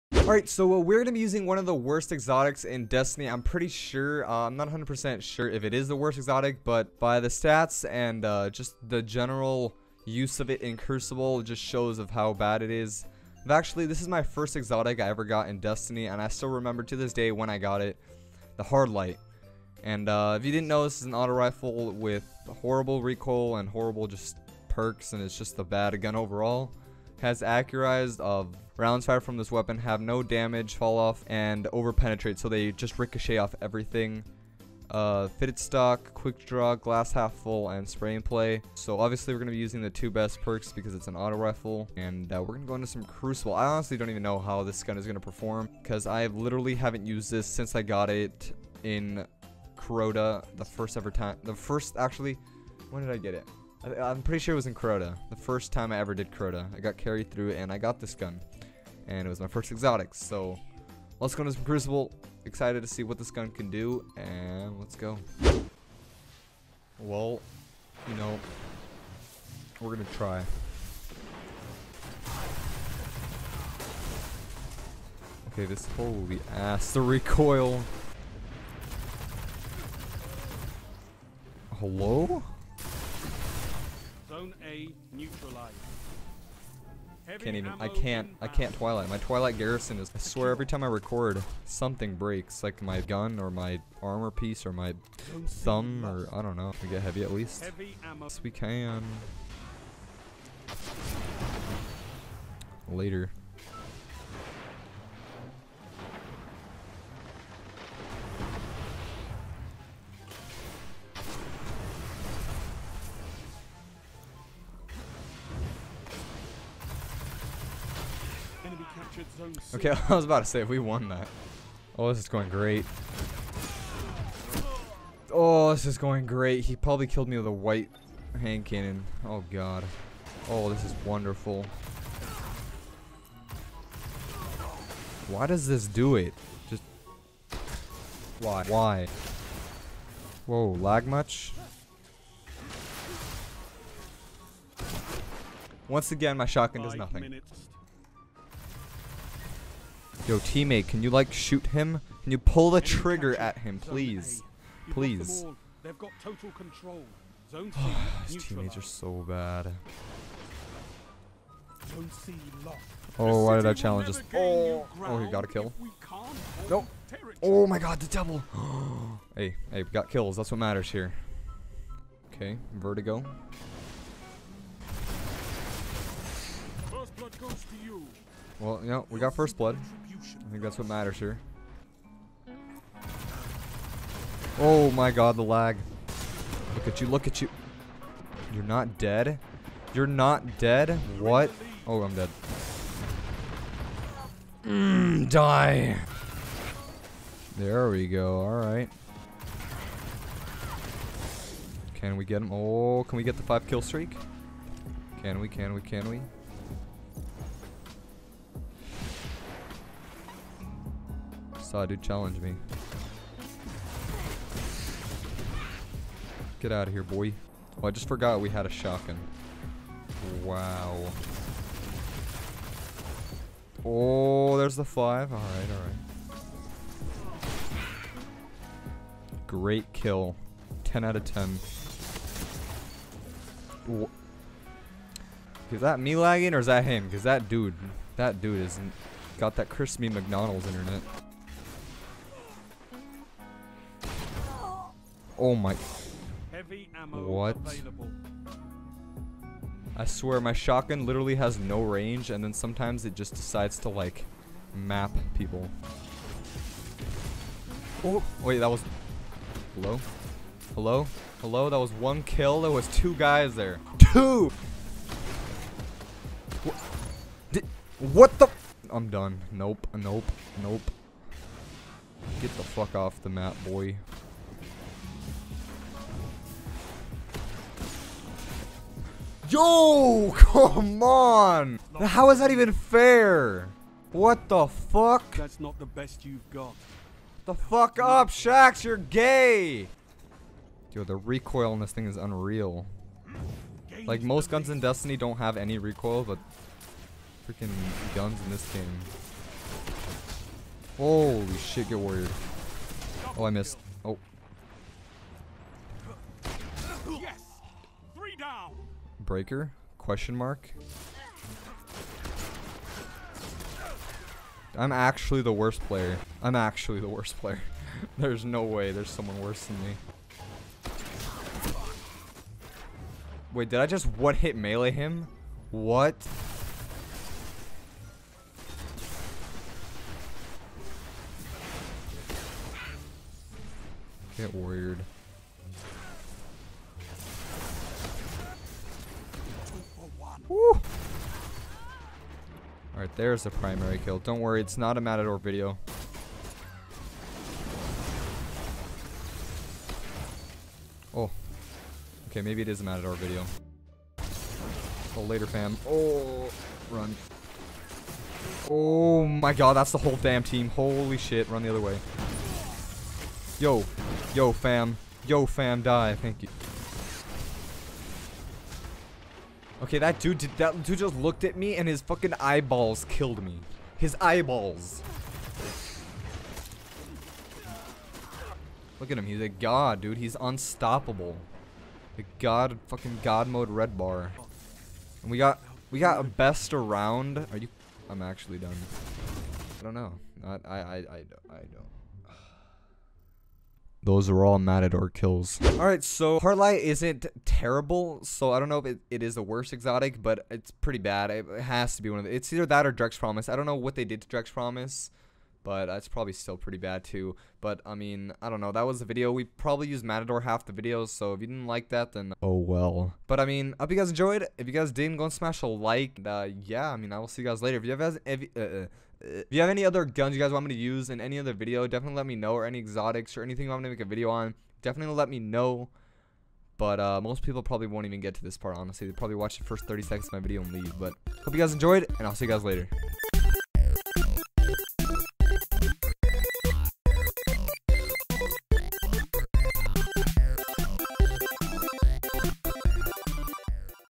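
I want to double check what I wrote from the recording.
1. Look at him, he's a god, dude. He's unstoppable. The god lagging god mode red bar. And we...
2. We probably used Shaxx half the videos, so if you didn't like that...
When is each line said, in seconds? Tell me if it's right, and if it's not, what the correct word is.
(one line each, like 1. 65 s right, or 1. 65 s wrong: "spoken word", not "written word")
1. 378 s wrong: "fucking", not "lagging"
2. 409 s wrong: "Matador", not "Shaxx".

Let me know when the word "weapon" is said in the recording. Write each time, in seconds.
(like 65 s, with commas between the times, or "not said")
29 s.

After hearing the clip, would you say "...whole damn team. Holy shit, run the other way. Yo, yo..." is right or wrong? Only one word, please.
right.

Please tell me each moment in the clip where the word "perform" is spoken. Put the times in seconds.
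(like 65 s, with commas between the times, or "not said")
45 s.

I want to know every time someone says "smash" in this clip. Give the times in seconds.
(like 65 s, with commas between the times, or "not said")
415 s.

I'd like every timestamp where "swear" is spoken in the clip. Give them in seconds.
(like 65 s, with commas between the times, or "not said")
90 s, 250 s.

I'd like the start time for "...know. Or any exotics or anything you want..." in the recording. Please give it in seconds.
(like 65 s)
422 s.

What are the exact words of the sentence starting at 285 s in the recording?
That's not the best you've got.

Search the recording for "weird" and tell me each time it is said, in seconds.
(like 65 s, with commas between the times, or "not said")
334 s.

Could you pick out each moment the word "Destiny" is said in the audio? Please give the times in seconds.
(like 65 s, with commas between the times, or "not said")
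2 s, 15 s, 294 s.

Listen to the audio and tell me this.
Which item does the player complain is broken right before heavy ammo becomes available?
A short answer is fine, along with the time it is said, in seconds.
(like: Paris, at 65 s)
Twilight Garrison, at 89 s.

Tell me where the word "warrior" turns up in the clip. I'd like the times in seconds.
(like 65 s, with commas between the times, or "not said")
301 s.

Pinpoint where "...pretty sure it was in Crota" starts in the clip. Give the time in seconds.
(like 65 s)
54 s.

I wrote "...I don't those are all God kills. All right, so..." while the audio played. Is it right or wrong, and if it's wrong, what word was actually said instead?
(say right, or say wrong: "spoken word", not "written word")
wrong: "Matador", not "God".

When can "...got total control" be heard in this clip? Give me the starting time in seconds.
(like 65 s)
155 s.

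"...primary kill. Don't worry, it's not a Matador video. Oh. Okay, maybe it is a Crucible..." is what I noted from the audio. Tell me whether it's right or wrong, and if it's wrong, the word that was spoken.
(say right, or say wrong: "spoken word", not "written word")
wrong: "Matador", not "Crucible".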